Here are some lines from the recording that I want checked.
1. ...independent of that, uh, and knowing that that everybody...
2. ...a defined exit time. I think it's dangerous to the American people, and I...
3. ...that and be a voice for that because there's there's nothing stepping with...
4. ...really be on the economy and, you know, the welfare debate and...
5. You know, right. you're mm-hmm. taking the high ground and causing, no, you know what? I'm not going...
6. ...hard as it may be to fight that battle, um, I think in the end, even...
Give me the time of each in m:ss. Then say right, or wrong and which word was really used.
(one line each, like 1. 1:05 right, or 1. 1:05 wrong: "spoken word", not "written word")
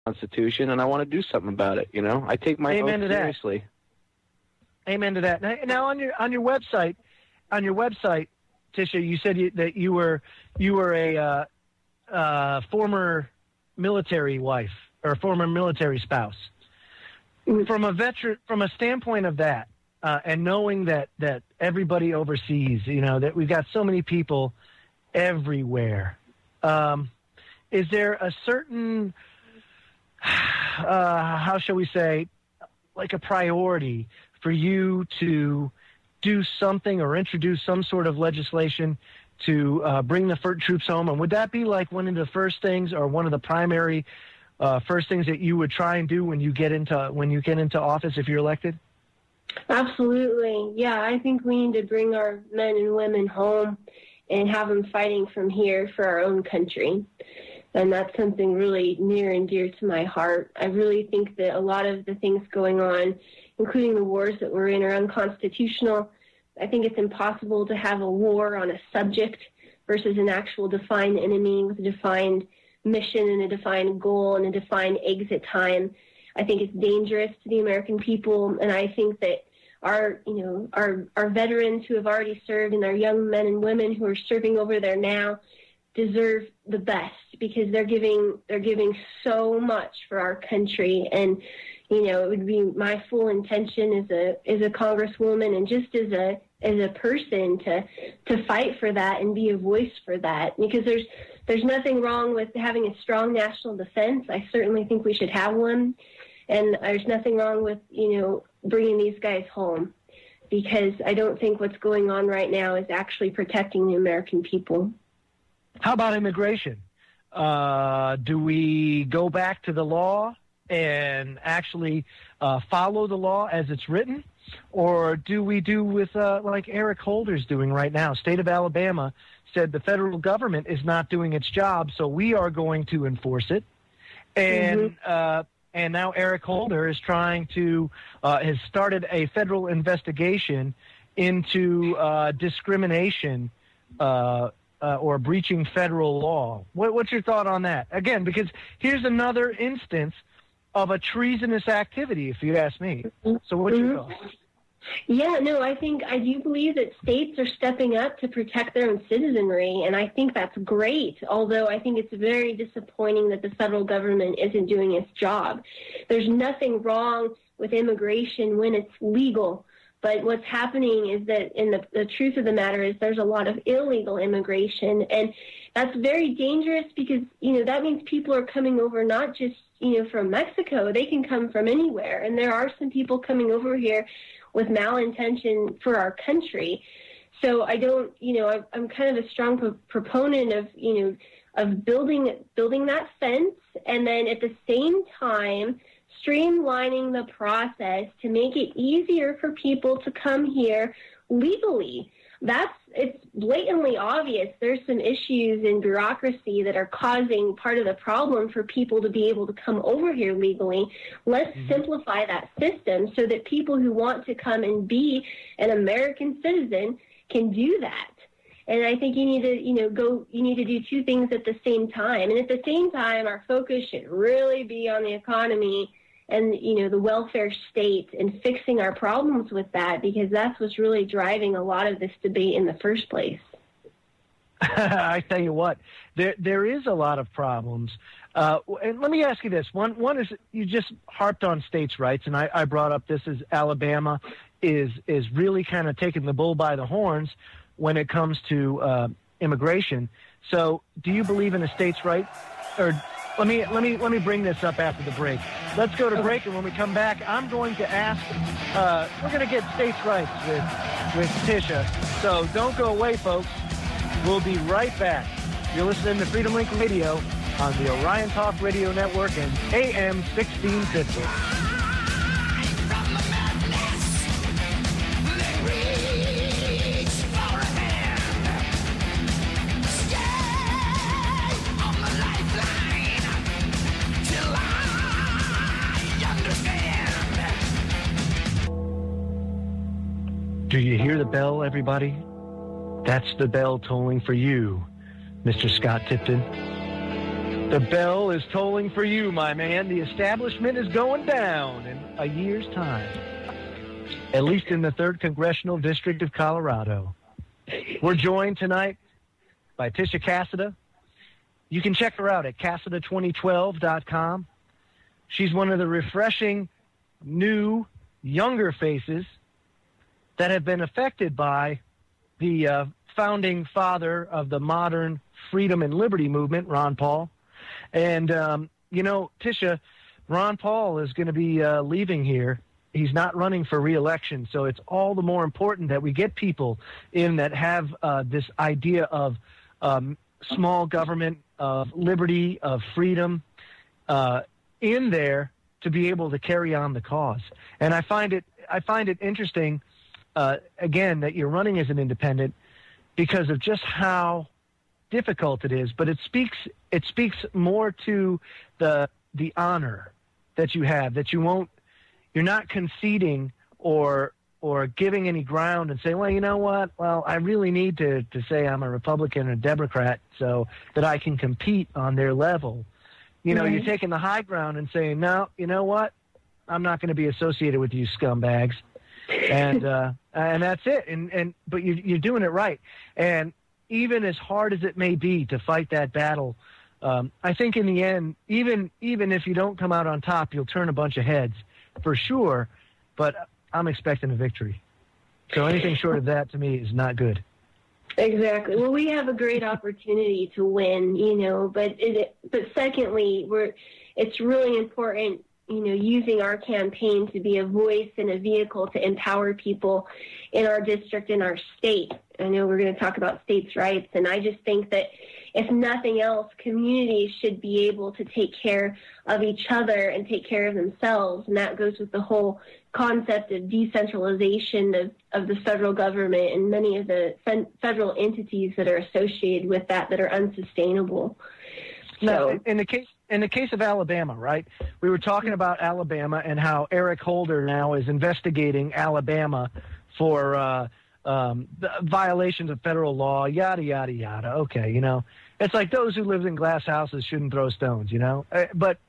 1. 0:18 wrong: "standpoint", not "independent"
2. 1:14 right
3. 1:38 wrong: "wrong", not "stepping"
4. 3:44 wrong: "state", not "debate"
5. 6:13 wrong: "saying", not "causing"
6. 6:24 right.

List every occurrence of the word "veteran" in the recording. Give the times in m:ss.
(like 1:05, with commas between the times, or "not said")
0:17, 1:21.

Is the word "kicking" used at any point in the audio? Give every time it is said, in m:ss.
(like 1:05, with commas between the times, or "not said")
not said.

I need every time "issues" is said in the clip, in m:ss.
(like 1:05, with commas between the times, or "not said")
3:25.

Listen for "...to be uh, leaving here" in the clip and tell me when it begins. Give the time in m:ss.
5:31.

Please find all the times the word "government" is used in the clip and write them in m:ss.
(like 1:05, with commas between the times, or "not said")
2:10, 2:43, 5:40, 7:05.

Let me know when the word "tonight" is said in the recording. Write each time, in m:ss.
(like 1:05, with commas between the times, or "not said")
5:08.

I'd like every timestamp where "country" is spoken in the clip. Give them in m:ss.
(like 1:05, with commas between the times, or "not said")
0:56, 1:30, 3:06.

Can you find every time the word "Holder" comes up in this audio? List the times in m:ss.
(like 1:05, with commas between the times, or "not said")
2:07, 2:16, 7:17.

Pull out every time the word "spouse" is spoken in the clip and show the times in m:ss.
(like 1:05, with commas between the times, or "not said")
0:15.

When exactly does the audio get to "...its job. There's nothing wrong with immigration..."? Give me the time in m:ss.
2:44.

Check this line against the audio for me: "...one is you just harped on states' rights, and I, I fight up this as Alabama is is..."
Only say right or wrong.
wrong.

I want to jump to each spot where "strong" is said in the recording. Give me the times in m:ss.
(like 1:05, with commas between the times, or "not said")
1:43, 3:09.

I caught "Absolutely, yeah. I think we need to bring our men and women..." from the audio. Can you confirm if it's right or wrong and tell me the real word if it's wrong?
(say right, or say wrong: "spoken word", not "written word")
right.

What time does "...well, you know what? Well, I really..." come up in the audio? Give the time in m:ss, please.
6:06.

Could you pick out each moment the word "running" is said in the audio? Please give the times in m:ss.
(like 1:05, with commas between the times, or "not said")
5:33, 5:51.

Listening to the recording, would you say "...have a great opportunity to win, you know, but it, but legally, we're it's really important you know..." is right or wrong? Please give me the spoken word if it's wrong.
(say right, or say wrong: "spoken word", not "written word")
wrong: "secondly", not "legally".